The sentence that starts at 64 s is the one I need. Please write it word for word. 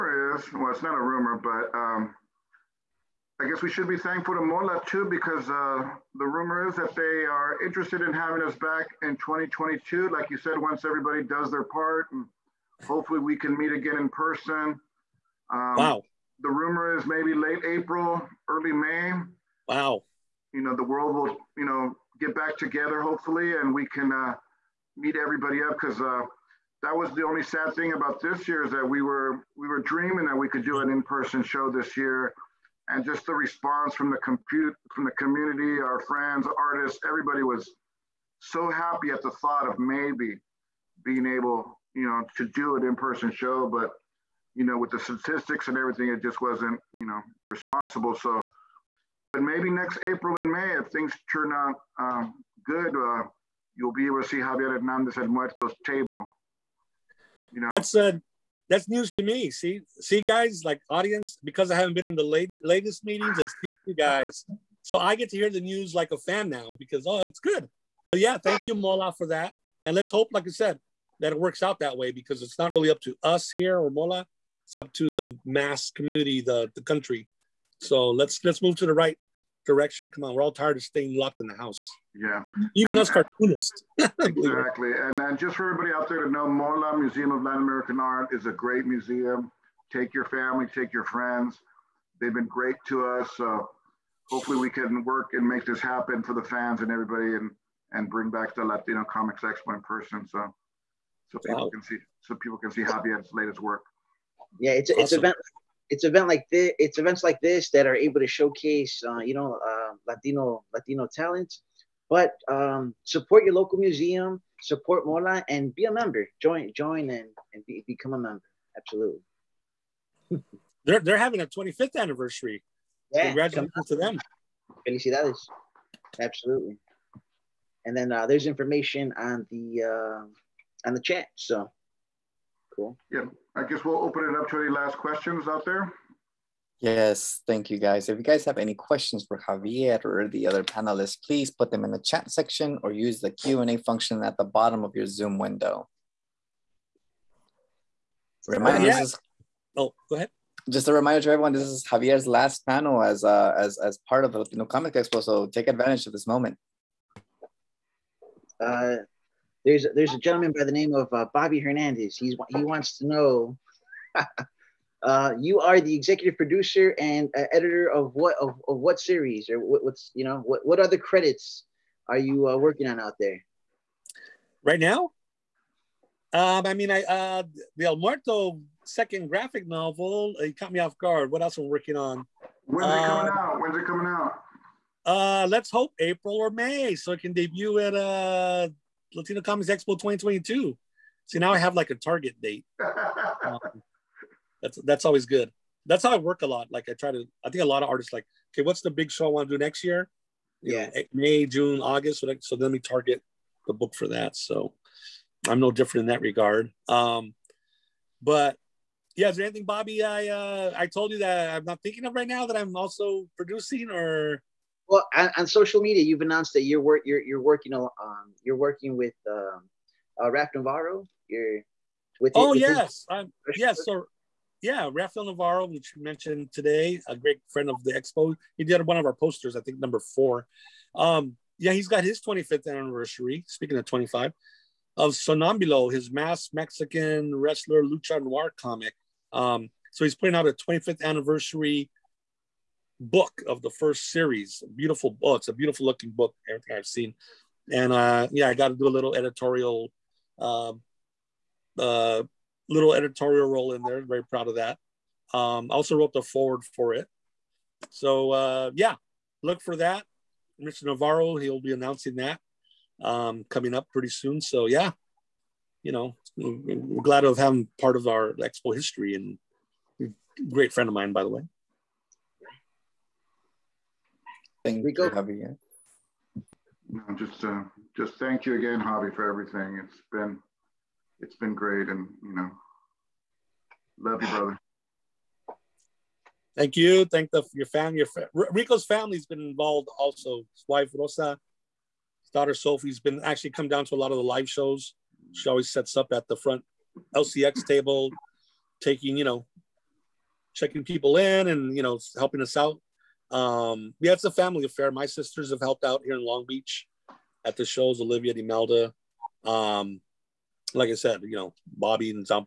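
So I get to hear the news like a fan now because oh, it's good.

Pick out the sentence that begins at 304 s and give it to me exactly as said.
My sisters have helped out here in Long Beach at the shows, Olivia, Imelda.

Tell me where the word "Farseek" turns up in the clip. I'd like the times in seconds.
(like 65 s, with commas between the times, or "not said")
not said.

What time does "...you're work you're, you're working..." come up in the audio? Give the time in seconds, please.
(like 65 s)
216 s.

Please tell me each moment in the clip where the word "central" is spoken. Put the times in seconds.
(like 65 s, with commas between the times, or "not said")
not said.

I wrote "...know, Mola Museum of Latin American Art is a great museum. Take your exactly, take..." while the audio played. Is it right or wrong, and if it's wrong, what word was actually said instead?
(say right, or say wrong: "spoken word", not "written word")
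wrong: "family", not "exactly".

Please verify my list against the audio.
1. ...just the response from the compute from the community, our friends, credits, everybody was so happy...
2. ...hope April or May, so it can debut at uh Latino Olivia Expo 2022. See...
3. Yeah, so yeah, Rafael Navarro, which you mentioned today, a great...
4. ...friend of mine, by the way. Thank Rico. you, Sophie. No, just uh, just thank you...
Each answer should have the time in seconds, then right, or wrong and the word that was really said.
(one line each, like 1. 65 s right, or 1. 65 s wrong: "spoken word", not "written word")
1. 33 s wrong: "artists", not "credits"
2. 185 s wrong: "Comics", not "Olivia"
3. 223 s right
4. 270 s wrong: "Javi", not "Sophie".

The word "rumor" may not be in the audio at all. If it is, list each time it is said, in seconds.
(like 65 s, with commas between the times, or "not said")
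1 s, 6 s, 16 s.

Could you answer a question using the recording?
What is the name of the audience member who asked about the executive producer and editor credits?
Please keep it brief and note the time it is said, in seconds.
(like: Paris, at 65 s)
Bobby Hernandez, at 161 s.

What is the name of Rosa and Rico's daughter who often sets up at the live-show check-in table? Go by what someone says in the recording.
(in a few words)
Sophie.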